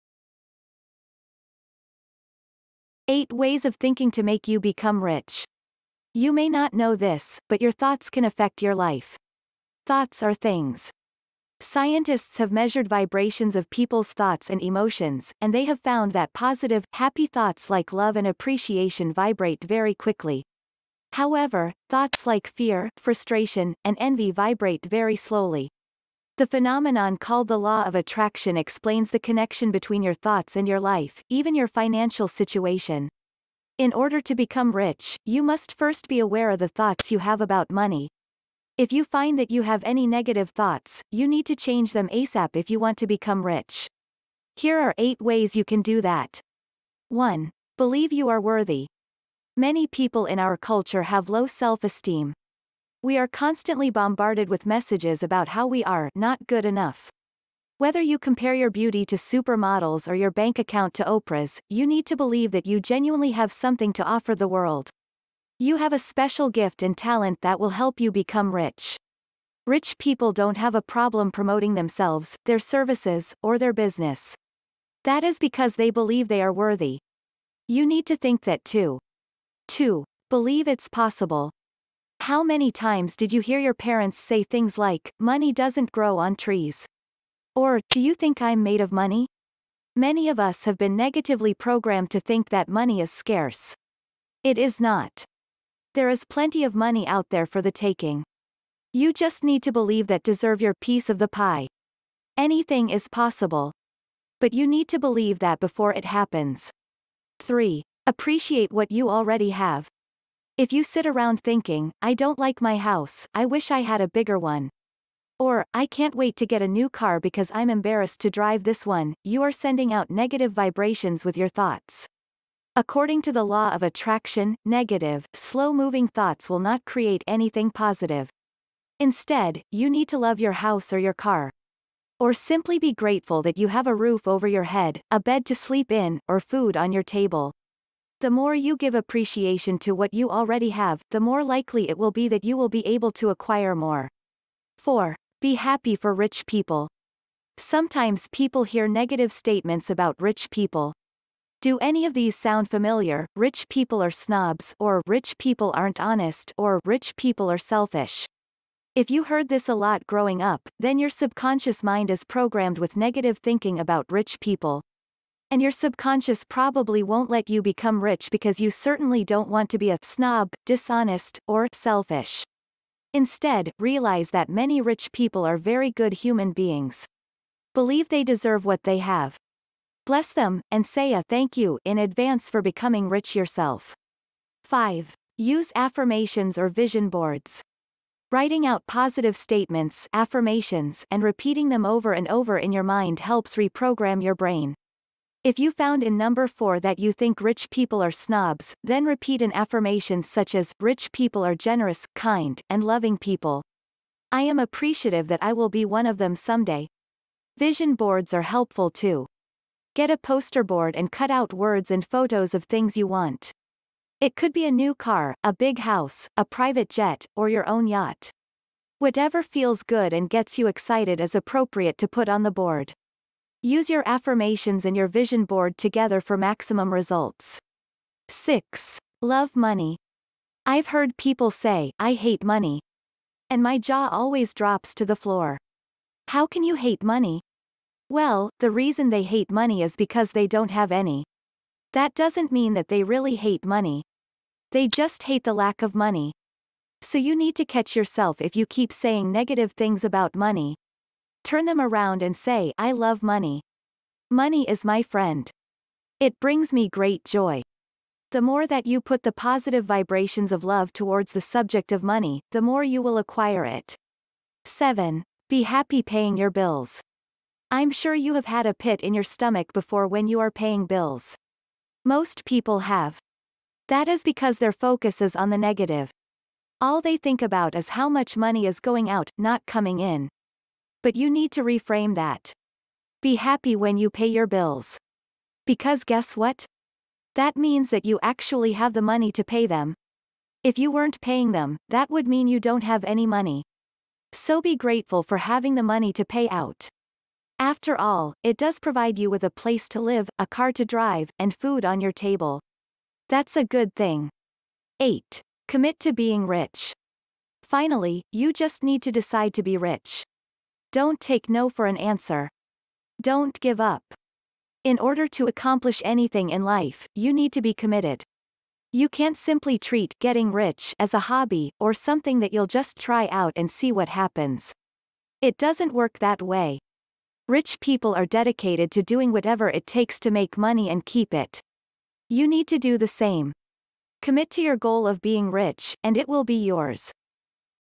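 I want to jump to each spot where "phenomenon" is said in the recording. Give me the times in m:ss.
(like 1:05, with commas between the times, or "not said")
0:26.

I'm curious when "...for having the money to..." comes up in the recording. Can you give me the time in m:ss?
4:55.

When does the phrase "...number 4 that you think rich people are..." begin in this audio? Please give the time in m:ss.
3:16.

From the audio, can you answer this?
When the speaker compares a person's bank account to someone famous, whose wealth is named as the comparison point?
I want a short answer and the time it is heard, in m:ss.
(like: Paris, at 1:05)
Oprah, at 1:01.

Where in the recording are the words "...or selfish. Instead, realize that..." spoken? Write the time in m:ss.
2:51.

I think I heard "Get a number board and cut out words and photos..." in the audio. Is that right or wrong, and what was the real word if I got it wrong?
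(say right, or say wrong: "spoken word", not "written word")
wrong: "poster", not "number".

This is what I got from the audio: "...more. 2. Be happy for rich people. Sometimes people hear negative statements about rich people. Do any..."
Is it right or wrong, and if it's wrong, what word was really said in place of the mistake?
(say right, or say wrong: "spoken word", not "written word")
wrong: "4", not "2".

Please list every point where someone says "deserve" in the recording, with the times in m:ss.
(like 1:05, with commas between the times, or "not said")
1:40, 2:58.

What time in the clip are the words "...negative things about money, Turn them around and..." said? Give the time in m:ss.
4:09.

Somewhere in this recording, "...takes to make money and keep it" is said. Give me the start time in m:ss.
5:29.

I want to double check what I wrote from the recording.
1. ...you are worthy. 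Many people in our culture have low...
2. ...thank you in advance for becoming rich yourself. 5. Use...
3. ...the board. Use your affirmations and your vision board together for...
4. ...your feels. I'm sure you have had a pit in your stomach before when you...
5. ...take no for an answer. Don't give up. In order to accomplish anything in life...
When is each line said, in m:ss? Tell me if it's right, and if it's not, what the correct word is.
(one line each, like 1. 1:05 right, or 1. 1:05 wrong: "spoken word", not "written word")
1. 0:48 right
2. 3:01 right
3. 3:42 right
4. 4:26 wrong: "bills", not "feels"
5. 5:11 right.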